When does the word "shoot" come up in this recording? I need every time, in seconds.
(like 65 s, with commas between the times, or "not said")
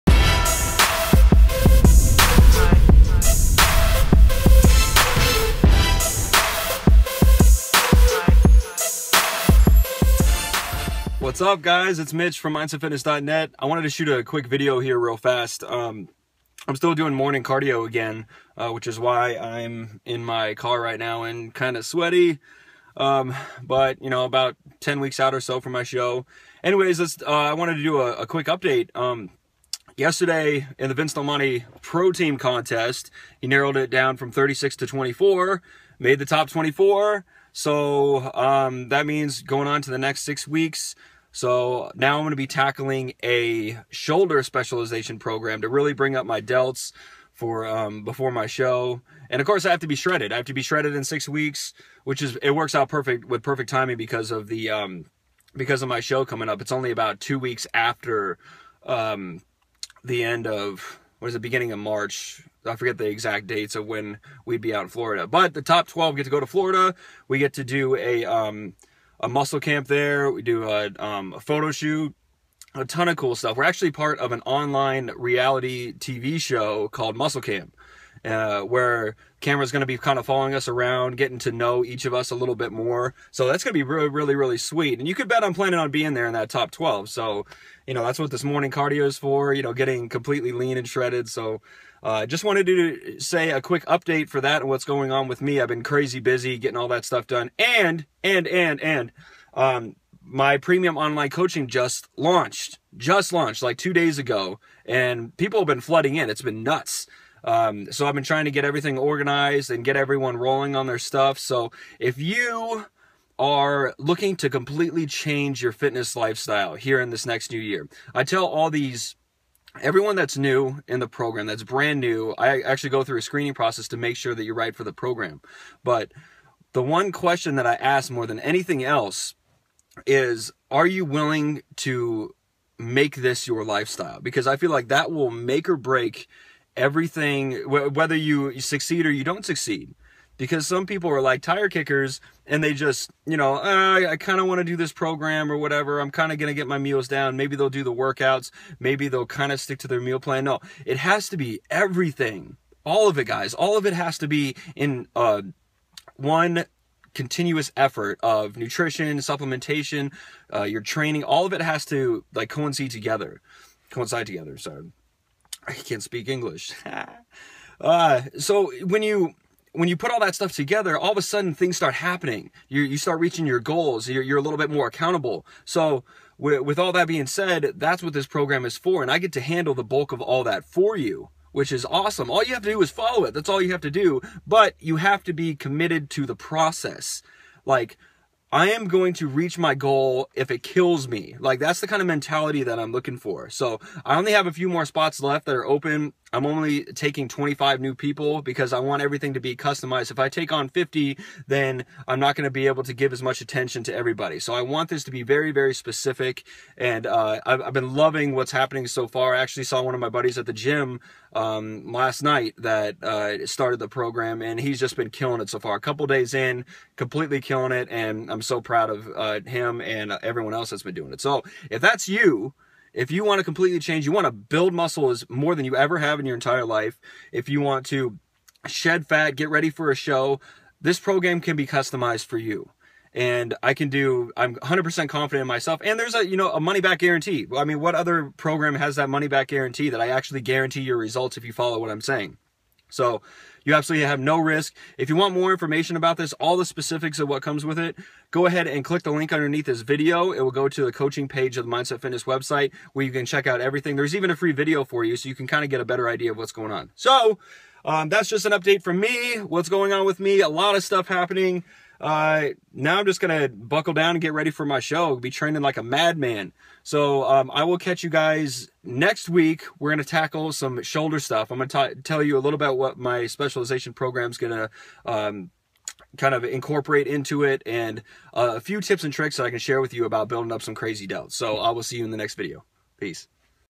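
13 s, 71 s.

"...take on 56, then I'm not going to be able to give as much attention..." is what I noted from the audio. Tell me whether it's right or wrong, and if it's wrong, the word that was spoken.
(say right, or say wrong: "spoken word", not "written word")
wrong: "50", not "56".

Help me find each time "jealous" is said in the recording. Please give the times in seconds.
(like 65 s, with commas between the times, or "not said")
not said.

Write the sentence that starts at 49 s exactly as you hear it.
And of course, I have to be shredded.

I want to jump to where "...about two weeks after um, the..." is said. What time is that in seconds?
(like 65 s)
56 s.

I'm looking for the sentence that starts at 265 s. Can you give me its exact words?
I'll be training like a madman.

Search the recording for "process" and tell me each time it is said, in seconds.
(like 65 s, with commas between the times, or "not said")
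123 s, 186 s.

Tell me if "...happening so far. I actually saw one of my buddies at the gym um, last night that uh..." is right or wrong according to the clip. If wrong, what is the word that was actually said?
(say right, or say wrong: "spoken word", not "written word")
right.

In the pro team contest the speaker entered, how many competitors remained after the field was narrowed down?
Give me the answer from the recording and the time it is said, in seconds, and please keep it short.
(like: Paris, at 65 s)
24, at 36 s.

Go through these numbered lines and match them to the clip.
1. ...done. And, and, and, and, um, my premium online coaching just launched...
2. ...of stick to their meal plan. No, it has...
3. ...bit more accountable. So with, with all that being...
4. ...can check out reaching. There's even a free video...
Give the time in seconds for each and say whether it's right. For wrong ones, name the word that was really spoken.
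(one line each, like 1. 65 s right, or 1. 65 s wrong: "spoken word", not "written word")
1. 97 s right
2. 149 s right
3. 174 s right
4. 253 s wrong: "everything", not "reaching".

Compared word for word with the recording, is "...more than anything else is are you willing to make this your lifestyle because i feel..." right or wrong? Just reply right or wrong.
right.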